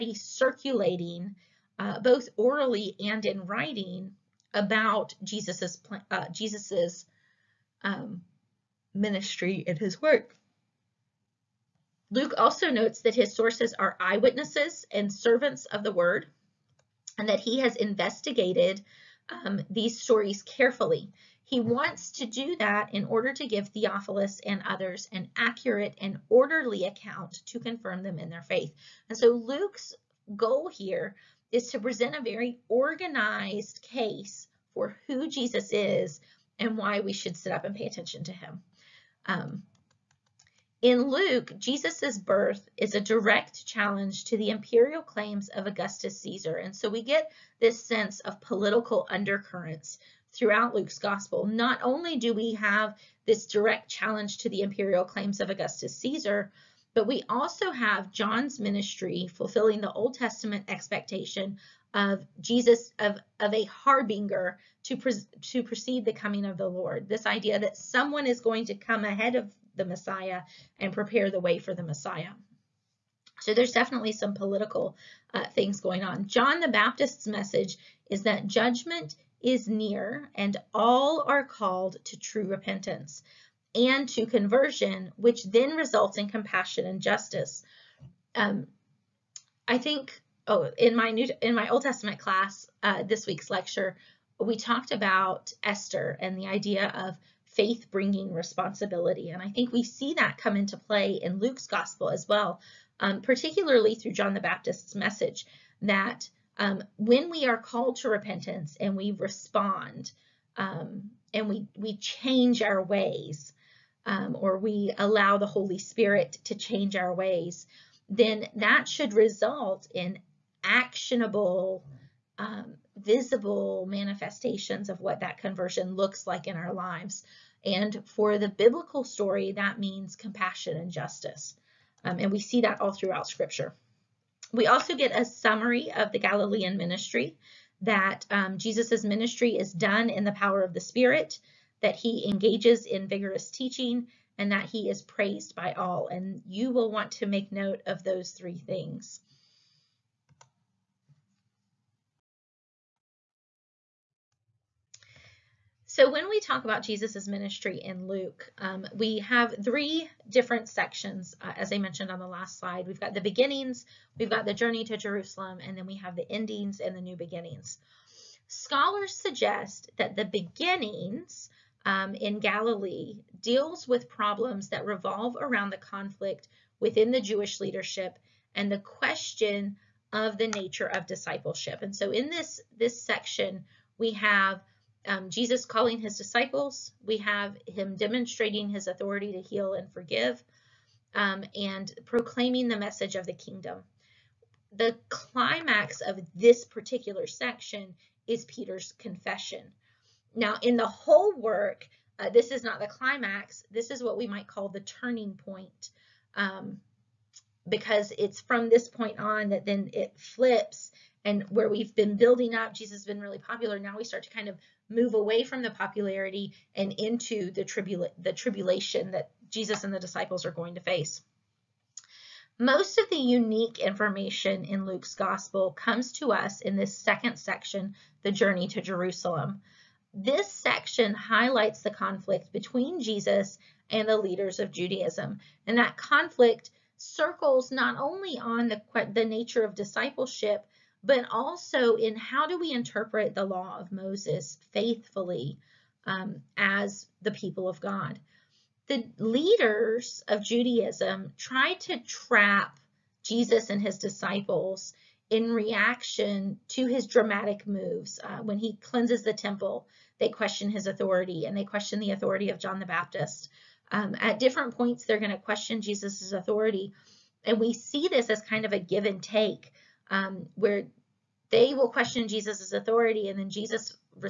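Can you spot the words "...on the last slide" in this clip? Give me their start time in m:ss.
2:42.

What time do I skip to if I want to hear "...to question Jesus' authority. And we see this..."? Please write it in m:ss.
4:25.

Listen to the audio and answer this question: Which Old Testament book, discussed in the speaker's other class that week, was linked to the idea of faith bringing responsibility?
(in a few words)
Esther.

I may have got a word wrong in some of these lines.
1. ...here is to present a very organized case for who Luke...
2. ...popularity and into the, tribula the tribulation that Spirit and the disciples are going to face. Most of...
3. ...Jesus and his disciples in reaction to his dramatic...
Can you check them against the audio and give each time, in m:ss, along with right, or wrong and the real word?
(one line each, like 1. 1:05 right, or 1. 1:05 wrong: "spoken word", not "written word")
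1. 0:30 wrong: "Jesus", not "Luke"
2. 3:35 wrong: "Jesus", not "Spirit"
3. 4:13 right.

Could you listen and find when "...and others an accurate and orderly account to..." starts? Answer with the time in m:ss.
0:24.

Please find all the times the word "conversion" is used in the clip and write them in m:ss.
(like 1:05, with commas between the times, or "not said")
1:24, 2:05.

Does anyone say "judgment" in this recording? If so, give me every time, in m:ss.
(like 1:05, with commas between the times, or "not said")
1:18.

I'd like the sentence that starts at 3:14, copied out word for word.
The climax of this particular section is Peter's confession.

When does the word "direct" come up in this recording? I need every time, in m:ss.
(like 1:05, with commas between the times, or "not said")
0:43, 0:53.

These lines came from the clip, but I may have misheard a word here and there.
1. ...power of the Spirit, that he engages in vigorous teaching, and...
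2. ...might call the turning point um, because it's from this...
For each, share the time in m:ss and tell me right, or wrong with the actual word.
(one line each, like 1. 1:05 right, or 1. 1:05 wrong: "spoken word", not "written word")
1. 2:20 right
2. 3:24 right.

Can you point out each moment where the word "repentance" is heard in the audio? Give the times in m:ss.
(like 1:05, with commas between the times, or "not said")
1:22, 1:48.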